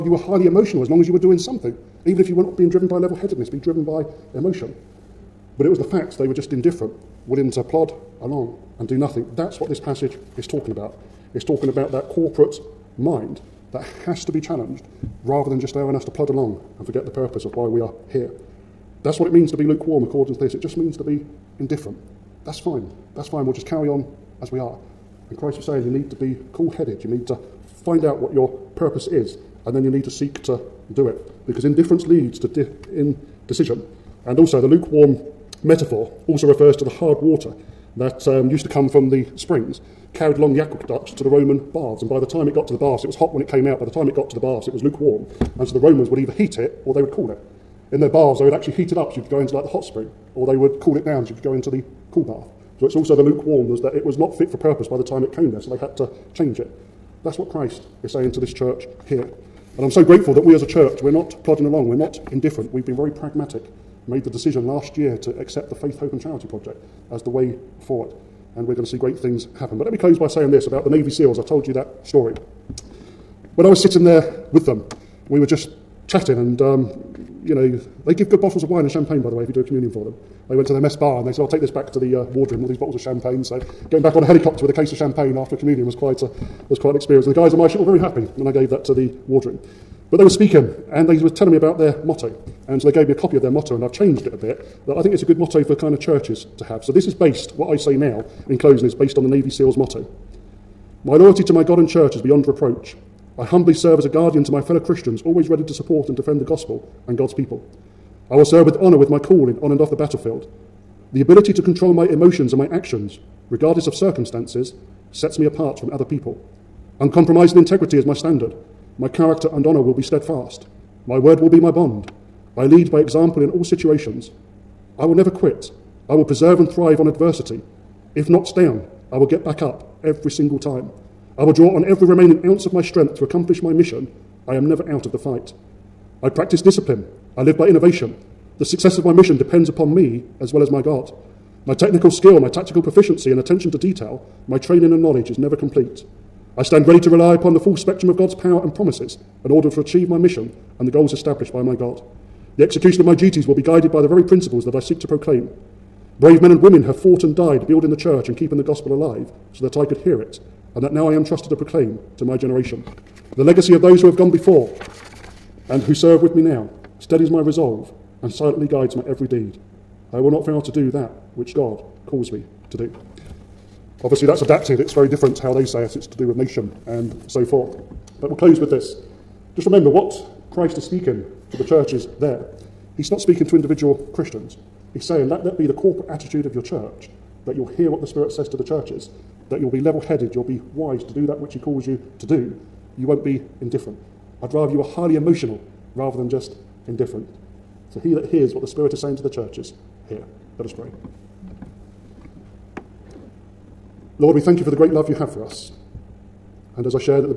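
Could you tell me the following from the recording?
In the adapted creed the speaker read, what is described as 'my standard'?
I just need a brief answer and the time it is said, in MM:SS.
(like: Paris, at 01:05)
Uncompromising integrity, at 01:56.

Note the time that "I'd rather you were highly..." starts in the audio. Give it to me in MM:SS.
03:14.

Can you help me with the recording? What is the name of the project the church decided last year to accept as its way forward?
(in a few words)
Faith, Hope and Charity Project.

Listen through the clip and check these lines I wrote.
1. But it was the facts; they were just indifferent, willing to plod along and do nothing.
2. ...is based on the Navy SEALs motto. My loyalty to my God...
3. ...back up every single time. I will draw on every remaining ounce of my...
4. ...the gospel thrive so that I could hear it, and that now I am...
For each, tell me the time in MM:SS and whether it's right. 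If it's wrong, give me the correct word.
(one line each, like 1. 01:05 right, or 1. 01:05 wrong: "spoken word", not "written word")
1. 00:05 right
2. 01:38 right
3. 02:09 right
4. 02:38 wrong: "alive", not "thrive".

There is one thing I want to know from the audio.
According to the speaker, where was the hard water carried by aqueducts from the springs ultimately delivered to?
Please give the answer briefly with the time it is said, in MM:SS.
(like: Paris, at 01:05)
Roman baths, at 00:41.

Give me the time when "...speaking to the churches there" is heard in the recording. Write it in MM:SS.
03:00.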